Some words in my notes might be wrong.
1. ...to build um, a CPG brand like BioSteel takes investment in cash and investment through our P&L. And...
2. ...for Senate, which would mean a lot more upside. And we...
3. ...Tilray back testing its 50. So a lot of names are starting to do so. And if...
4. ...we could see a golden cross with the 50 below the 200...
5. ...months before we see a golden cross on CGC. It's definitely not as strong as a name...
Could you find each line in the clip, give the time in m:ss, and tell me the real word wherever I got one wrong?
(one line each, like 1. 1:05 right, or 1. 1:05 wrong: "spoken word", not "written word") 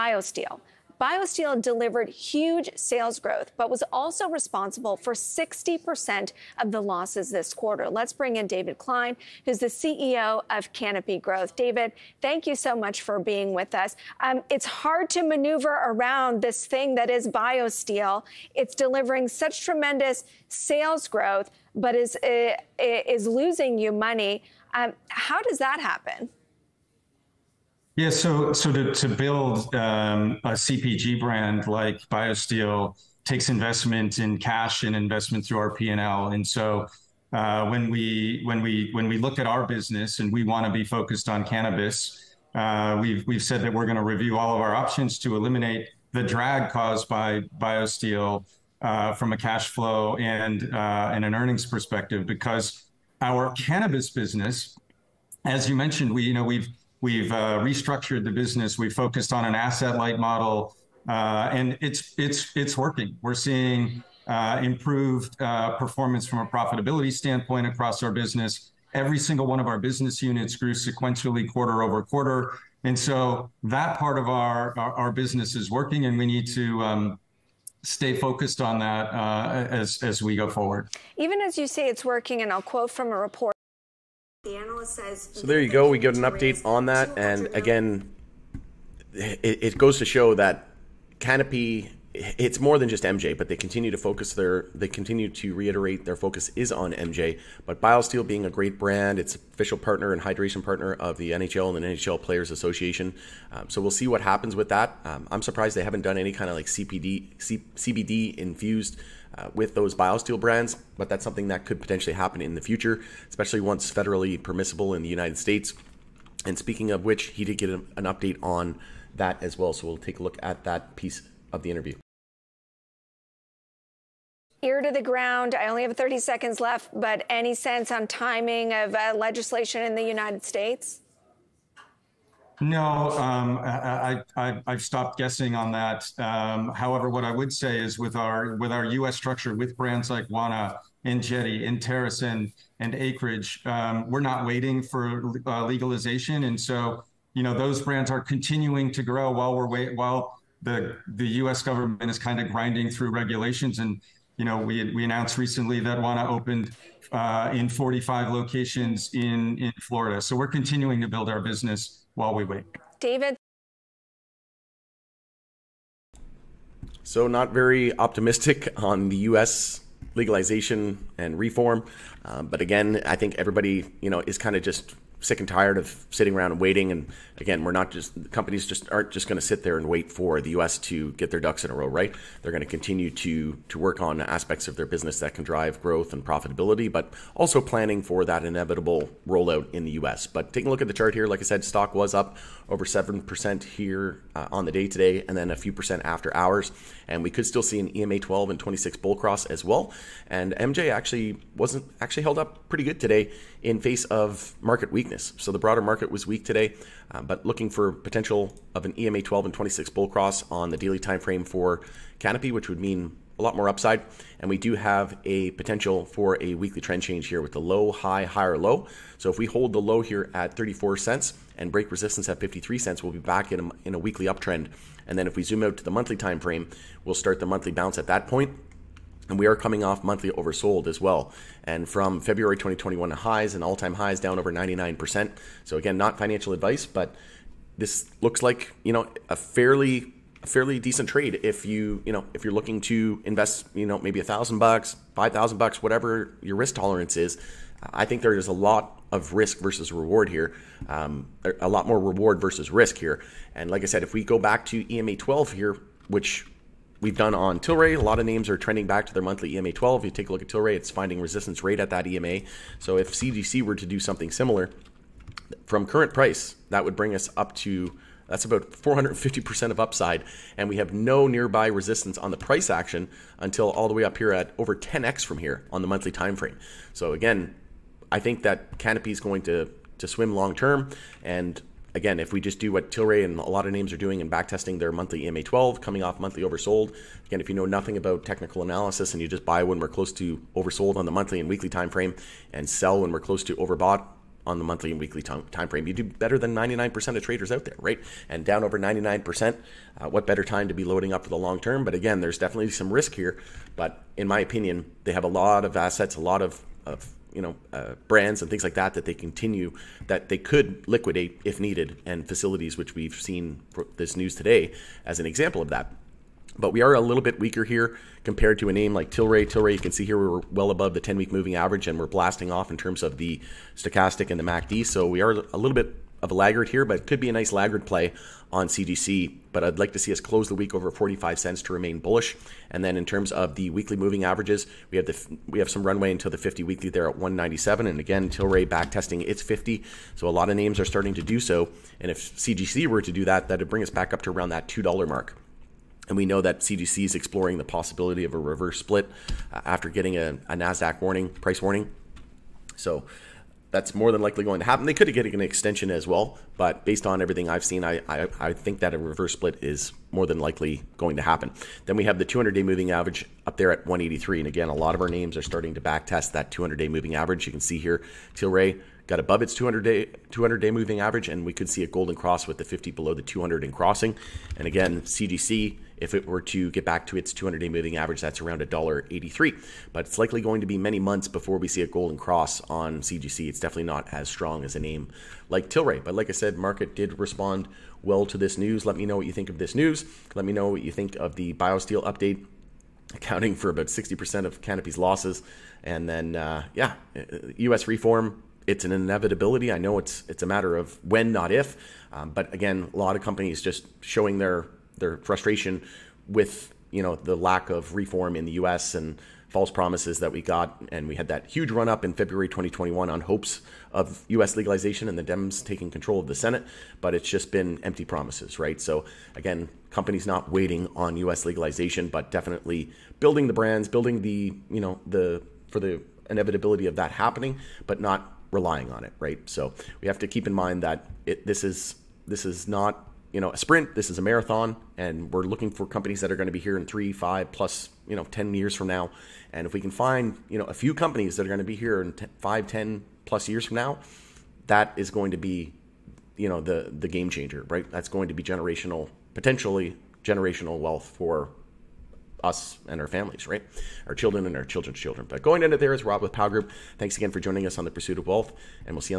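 1. 0:28 right
2. 3:31 wrong: "Canopy", not "Senate"
3. 5:38 right
4. 6:11 right
5. 6:20 right.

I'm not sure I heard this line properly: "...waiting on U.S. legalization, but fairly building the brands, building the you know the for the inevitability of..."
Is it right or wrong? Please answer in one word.
wrong.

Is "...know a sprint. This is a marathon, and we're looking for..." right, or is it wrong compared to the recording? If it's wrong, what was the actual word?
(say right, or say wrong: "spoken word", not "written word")
right.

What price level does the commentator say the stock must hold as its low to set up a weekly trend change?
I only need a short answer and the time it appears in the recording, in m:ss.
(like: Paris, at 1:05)
34 cents, at 3:40.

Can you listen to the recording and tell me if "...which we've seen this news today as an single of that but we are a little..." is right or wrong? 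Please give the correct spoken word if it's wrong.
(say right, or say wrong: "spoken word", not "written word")
wrong: "example", not "single".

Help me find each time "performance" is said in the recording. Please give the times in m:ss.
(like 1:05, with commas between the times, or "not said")
1:05.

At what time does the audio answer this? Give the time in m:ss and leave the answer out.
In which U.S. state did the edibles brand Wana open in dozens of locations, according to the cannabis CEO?
2:39.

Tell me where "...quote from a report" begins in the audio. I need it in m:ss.
1:22.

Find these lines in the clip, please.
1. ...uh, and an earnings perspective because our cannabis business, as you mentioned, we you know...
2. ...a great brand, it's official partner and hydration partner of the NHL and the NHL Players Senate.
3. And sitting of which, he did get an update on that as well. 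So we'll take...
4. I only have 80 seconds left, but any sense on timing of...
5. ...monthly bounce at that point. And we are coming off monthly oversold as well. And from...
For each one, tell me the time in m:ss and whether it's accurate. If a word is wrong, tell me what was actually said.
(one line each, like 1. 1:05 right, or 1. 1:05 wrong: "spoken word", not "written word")
1. 0:50 right
2. 1:38 wrong: "Association", not "Senate"
3. 1:56 wrong: "speaking", not "sitting"
4. 2:05 wrong: "30", not "80"
5. 3:47 right.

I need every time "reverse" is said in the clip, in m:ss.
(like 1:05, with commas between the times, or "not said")
5:48, 5:58.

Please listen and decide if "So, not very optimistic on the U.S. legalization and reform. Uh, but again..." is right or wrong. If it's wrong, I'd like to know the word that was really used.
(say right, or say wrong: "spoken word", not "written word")
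right.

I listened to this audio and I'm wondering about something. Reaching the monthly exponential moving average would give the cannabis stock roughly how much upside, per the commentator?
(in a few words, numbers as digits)
450%.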